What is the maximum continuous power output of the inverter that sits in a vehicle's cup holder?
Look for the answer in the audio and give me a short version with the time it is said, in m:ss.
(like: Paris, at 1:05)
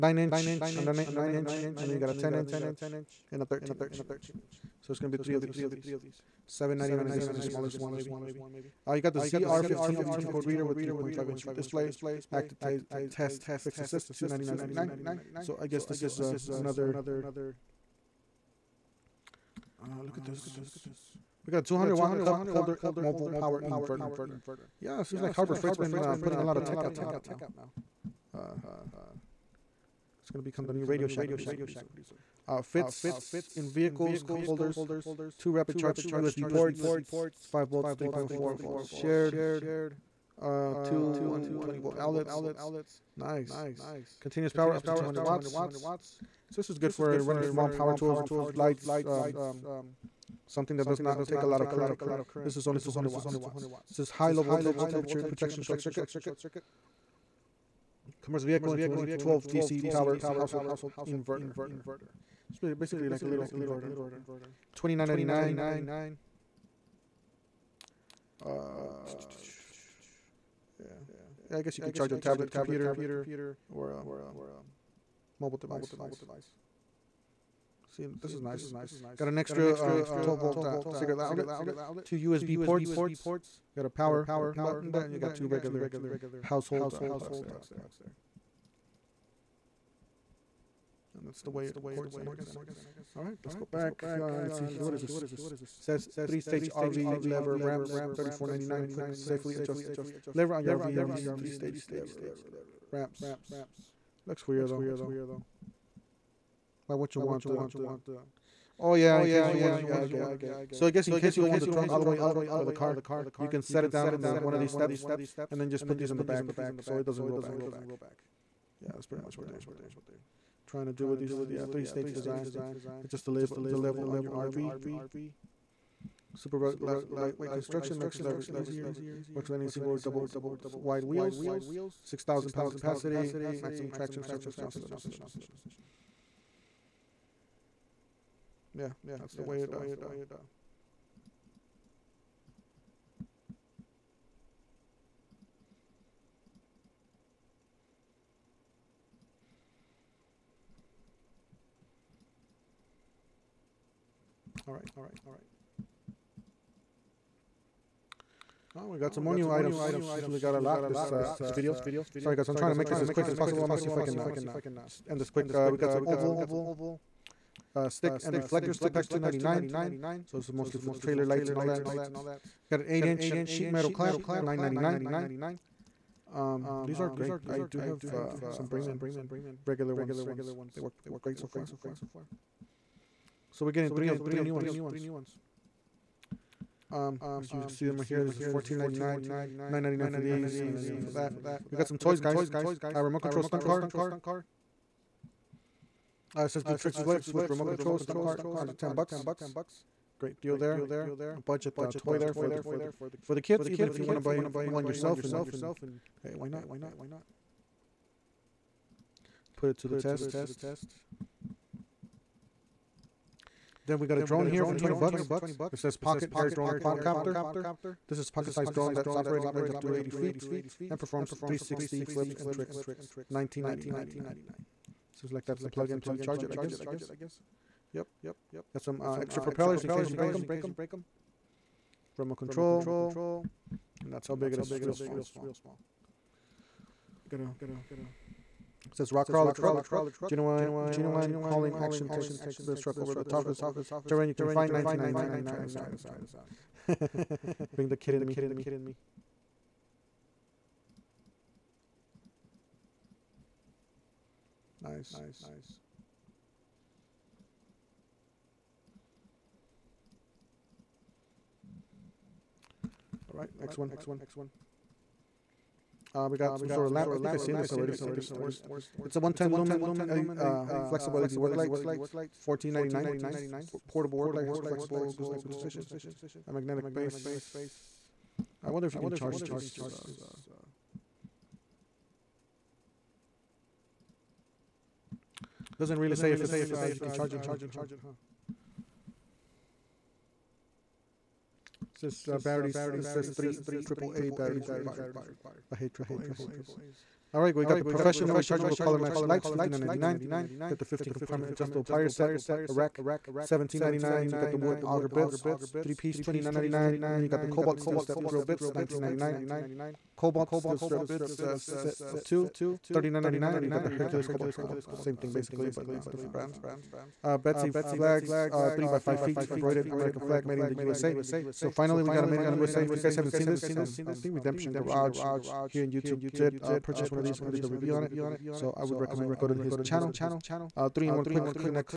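200 watts, at 0:44.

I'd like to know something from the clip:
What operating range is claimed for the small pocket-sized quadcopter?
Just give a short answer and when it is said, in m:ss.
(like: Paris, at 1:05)
80 feet, at 3:39.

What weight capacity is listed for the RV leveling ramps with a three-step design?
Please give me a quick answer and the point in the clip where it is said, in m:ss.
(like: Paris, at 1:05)
6,000 pounds, at 2:12.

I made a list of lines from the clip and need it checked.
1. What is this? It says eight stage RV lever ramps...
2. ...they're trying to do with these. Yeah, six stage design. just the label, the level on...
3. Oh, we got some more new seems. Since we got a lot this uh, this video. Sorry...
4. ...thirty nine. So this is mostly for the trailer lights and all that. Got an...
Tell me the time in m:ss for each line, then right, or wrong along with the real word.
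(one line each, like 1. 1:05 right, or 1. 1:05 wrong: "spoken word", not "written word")
1. 1:34 wrong: "three", not "eight"
2. 1:59 wrong: "three", not "six"
3. 2:38 wrong: "items", not "seems"
4. 2:49 wrong: "ninety", not "thirty".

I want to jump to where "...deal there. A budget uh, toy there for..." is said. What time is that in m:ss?
3:20.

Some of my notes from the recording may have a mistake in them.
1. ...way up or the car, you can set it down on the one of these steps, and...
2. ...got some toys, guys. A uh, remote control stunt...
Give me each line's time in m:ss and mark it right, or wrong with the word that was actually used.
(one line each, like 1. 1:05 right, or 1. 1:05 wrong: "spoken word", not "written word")
1. 1:52 right
2. 3:11 right.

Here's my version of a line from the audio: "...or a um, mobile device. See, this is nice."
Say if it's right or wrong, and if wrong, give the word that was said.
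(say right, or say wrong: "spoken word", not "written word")
right.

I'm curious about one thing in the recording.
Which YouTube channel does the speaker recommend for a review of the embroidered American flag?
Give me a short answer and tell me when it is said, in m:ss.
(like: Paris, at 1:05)
Redemption Garage, at 5:24.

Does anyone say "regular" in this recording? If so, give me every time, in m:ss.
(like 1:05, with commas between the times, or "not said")
1:25, 2:59.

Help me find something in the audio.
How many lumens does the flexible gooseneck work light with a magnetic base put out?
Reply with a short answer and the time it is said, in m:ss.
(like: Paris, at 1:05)
110, at 4:29.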